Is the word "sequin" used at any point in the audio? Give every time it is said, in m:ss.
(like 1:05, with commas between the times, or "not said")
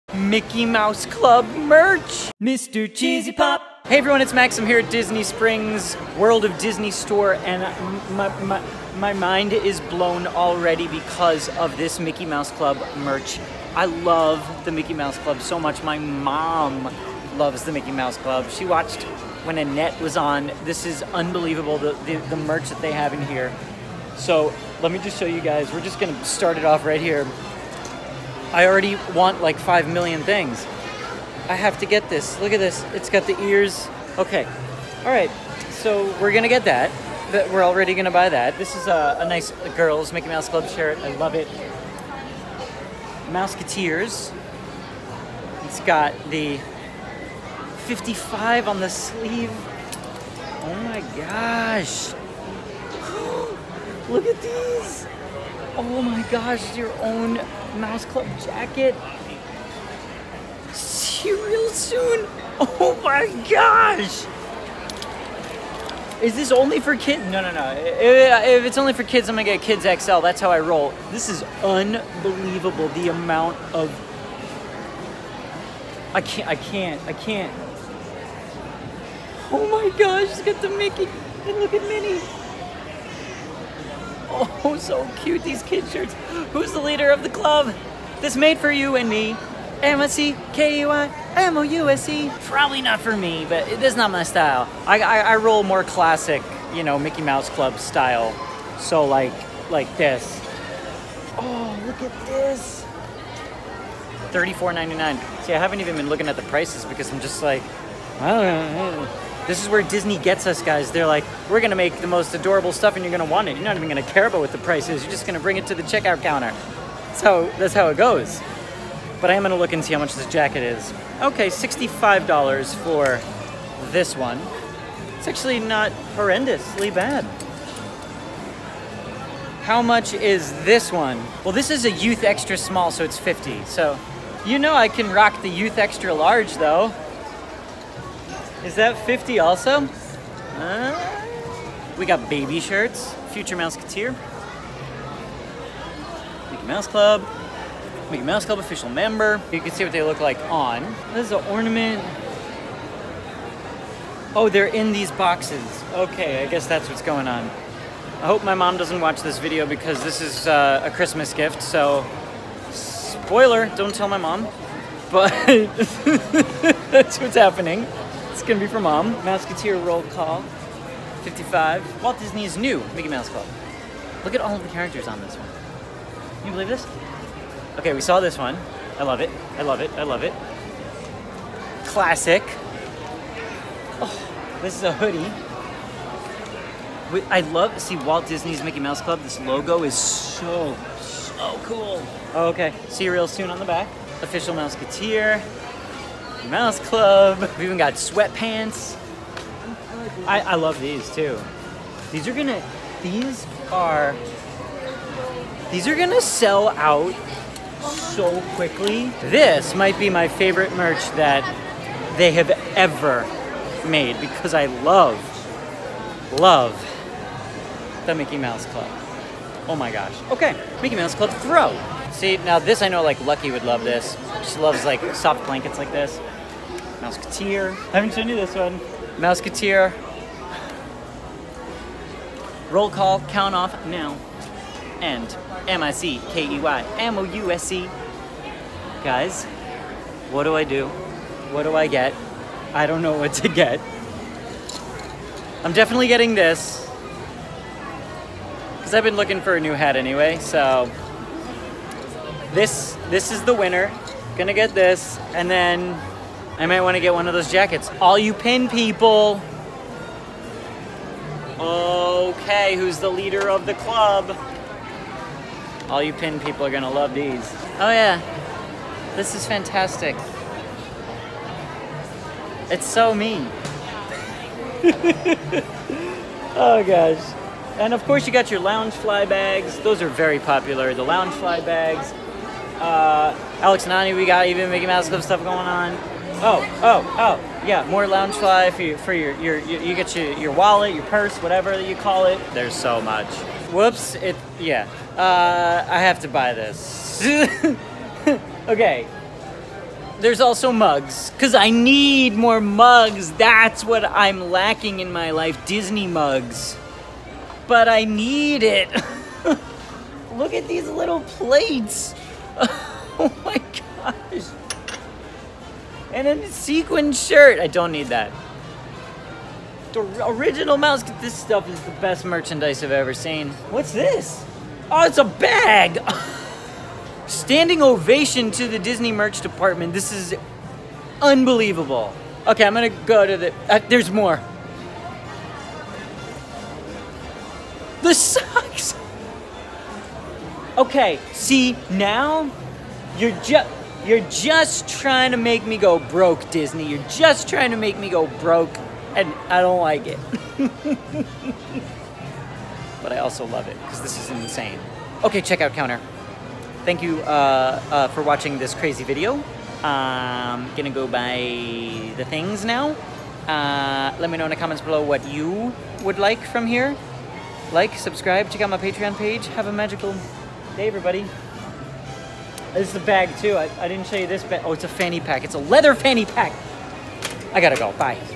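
5:16.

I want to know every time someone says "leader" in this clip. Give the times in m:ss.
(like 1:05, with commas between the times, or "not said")
1:26, 4:23.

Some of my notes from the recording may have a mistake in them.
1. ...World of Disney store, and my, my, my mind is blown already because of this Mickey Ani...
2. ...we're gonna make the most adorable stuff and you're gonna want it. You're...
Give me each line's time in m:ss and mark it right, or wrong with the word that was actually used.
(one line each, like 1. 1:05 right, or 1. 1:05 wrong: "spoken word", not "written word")
1. 0:06 wrong: "Mouse", not "Ani"
2. 1:51 right.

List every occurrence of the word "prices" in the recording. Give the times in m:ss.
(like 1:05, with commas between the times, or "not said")
1:46, 1:54.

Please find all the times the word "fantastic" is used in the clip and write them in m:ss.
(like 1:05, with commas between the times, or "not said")
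4:29.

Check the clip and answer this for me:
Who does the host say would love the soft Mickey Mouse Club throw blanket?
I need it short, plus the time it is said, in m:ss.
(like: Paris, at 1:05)
Lucky, at 3:43.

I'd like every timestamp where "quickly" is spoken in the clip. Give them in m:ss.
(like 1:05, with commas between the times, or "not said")
3:28.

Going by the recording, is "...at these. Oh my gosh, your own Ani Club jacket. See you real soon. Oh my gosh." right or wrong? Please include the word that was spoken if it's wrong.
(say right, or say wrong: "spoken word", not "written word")
wrong: "Mouse", not "Ani".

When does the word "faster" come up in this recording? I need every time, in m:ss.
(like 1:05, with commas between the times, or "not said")
not said.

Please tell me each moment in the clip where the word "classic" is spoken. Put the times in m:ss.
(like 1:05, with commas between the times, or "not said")
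1:35, 3:01.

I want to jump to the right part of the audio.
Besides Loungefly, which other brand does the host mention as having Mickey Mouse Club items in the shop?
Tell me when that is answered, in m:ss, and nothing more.
4:43.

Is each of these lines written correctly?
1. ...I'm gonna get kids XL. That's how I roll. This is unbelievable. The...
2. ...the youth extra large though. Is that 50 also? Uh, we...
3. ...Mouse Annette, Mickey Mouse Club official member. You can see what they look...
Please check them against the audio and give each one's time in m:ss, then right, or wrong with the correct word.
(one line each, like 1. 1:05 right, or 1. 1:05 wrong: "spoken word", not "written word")
1. 1:09 right
2. 2:15 right
3. 2:26 wrong: "Club", not "Annette".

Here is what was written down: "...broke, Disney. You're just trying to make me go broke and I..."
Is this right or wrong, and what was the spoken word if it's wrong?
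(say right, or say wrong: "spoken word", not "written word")
right.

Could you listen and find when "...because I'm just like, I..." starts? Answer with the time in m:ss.
1:46.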